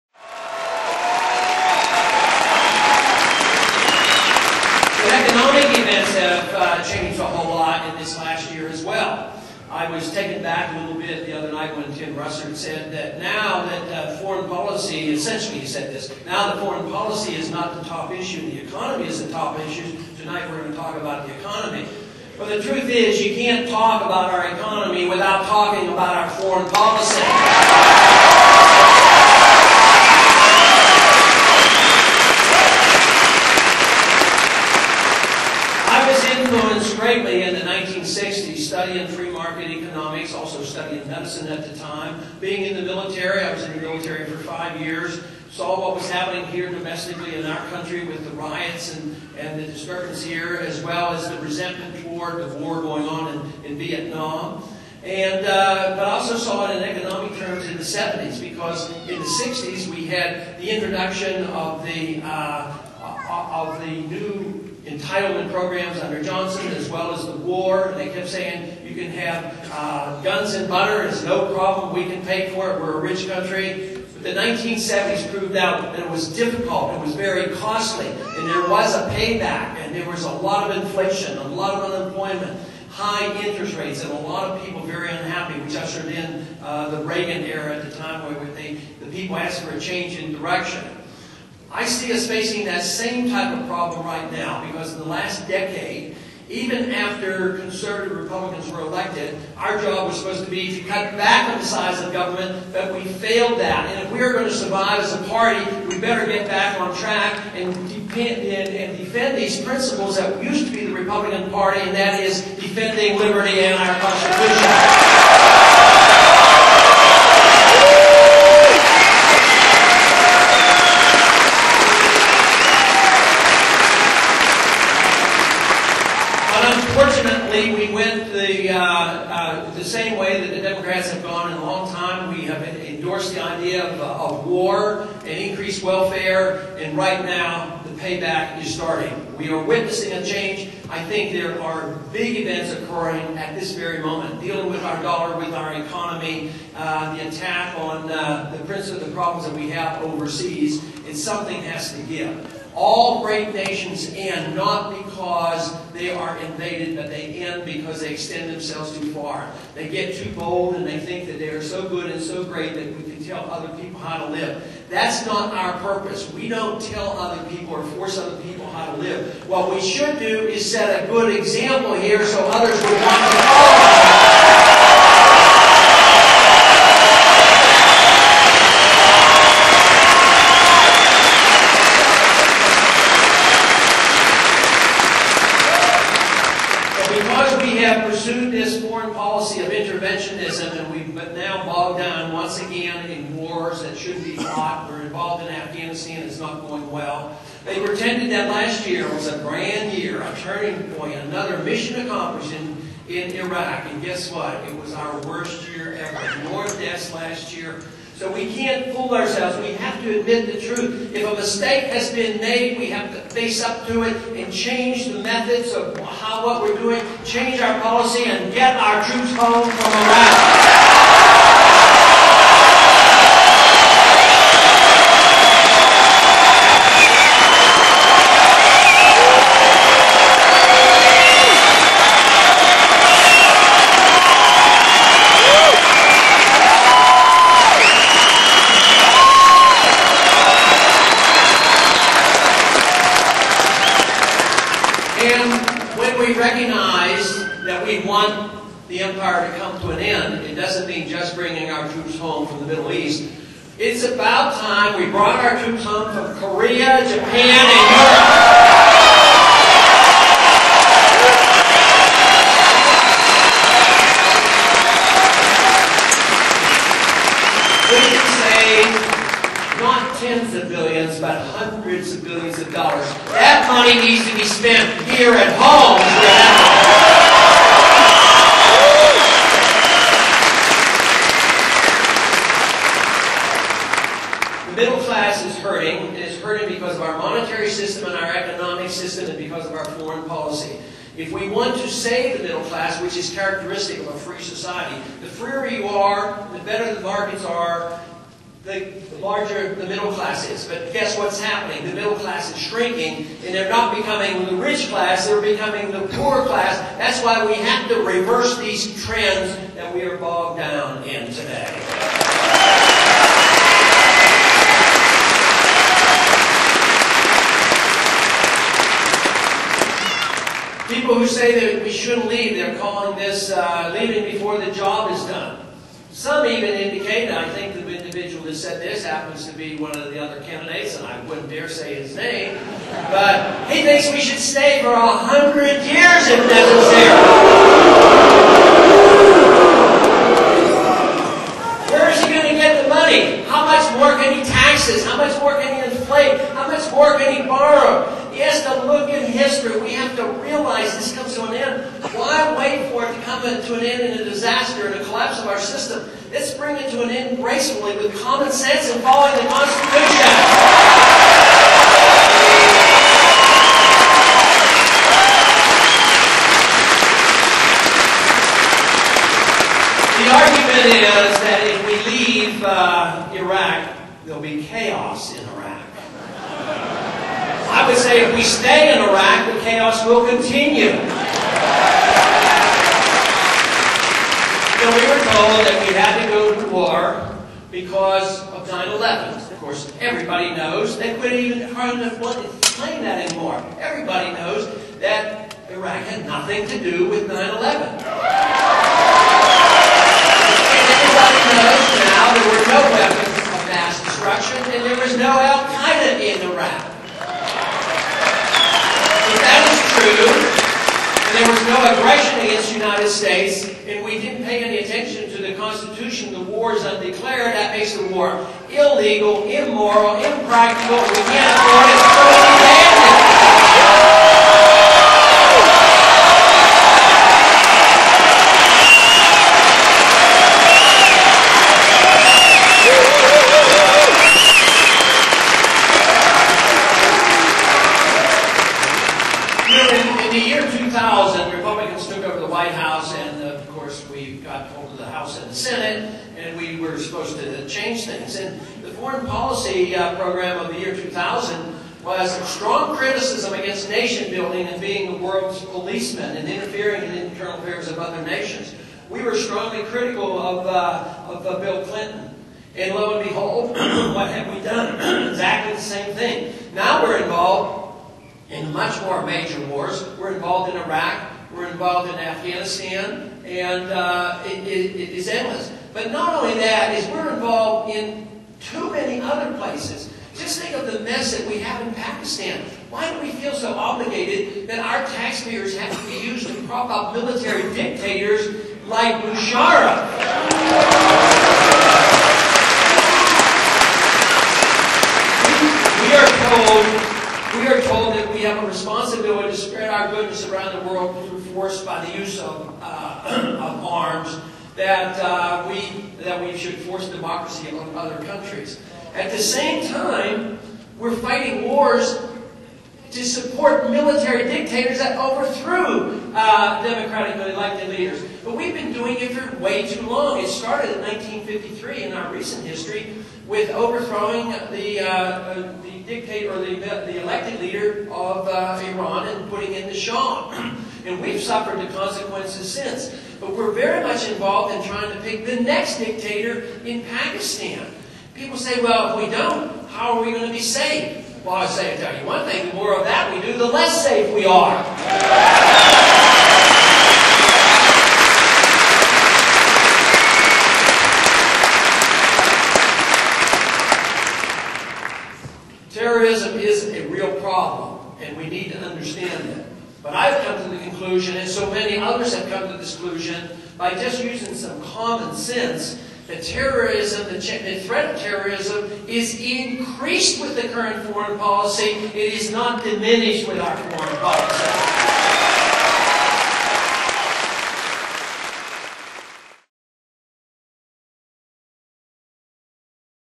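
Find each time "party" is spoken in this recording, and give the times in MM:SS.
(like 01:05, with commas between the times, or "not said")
01:45, 01:51.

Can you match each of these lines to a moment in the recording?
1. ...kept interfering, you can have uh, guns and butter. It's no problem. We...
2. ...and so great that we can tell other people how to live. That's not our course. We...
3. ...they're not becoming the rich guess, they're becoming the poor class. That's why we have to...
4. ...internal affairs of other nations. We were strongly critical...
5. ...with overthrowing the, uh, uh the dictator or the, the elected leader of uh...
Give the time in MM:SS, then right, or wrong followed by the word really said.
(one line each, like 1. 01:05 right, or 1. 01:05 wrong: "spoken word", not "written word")
1. 01:08 wrong: "saying", not "interfering"
2. 02:42 wrong: "purpose", not "course"
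3. 05:03 wrong: "class", not "guess"
4. 07:37 right
5. 08:43 right.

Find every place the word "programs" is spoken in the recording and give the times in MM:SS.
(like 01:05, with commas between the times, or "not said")
01:05, 07:30.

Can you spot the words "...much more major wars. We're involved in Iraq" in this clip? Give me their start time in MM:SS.
07:48.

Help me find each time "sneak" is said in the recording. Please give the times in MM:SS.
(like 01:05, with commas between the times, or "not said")
not said.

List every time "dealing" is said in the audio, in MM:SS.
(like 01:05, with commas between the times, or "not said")
02:24.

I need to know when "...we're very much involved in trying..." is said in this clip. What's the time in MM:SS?
08:53.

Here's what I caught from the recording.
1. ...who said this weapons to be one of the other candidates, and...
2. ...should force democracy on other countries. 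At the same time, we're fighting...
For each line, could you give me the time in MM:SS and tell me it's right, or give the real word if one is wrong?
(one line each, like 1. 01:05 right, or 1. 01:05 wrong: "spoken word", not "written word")
1. 05:28 wrong: "happens", not "weapons"
2. 08:26 right.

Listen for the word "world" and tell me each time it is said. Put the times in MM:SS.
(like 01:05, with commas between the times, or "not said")
07:35, 08:20.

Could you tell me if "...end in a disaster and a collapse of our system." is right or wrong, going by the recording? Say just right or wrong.
right.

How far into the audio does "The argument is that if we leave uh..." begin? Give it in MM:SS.
06:10.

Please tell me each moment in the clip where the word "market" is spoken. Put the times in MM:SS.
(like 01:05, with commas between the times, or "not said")
00:39, 04:57.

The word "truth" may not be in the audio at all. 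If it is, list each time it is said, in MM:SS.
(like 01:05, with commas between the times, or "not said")
00:22, 03:30.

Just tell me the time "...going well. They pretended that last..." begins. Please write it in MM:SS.
03:16.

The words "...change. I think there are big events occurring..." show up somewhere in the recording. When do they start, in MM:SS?
02:20.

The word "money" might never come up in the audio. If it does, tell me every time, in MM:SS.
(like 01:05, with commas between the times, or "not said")
04:33, 05:42.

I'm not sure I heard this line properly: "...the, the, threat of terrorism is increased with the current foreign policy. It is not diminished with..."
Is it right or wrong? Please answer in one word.
right.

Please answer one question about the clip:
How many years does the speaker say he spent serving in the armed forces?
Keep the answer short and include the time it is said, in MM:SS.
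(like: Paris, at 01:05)
5, at 00:44.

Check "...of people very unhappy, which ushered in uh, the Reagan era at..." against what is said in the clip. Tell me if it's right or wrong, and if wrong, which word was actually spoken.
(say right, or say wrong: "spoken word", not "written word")
right.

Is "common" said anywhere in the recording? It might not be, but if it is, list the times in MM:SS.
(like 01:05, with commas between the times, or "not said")
05:58, 09:24.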